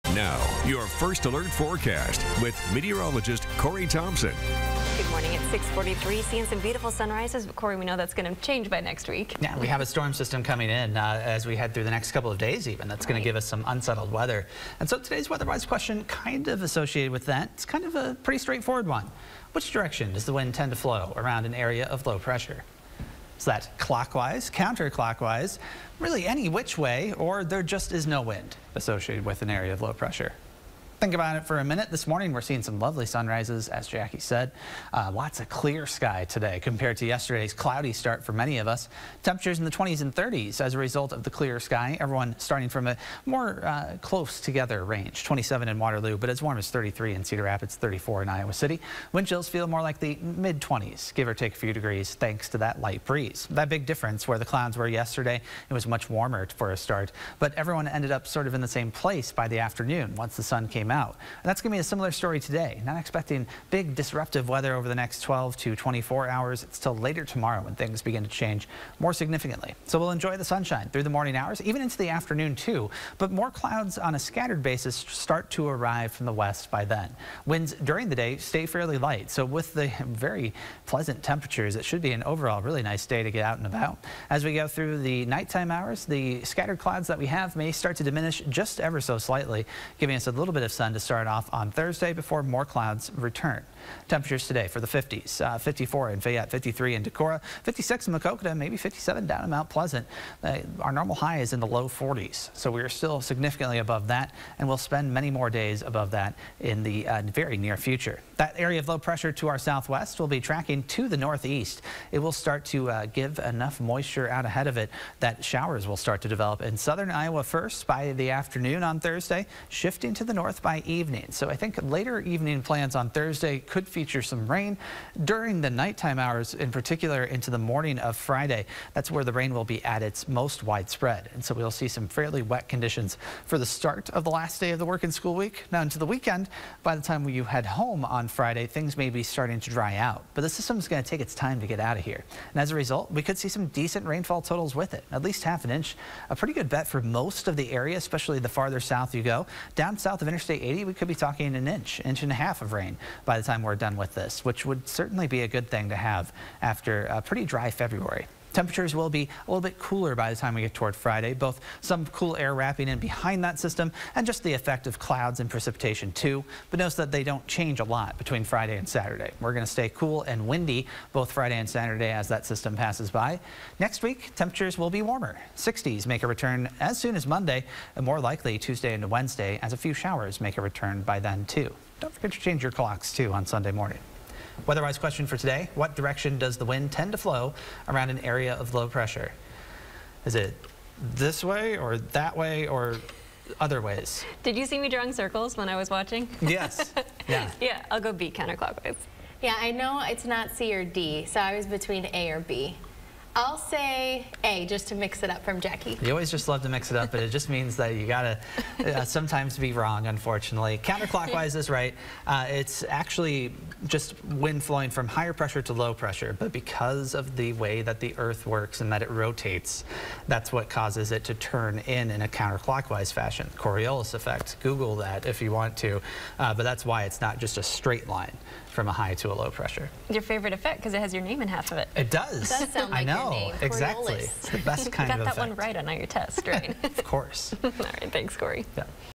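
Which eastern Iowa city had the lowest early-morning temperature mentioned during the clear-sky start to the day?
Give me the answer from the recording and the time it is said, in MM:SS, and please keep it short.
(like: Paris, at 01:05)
Waterloo, at 00:45.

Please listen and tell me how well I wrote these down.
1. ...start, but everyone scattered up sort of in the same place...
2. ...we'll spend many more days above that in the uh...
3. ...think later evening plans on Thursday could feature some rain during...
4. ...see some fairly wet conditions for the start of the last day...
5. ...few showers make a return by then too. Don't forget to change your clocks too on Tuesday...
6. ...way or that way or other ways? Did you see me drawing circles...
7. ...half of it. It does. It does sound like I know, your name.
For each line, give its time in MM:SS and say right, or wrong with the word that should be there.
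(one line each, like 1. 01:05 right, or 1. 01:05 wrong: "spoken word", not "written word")
1. 00:56 wrong: "ended", not "scattered"
2. 01:44 right
3. 02:01 right
4. 02:11 right
5. 02:59 wrong: "Sunday", not "Tuesday"
6. 03:11 right
7. 03:51 right.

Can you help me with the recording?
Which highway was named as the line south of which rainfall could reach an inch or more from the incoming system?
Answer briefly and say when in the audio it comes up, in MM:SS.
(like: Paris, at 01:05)
Interstate 80, at 02:30.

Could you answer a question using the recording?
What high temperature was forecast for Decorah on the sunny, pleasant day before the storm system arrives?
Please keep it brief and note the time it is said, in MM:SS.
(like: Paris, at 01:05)
53, at 01:36.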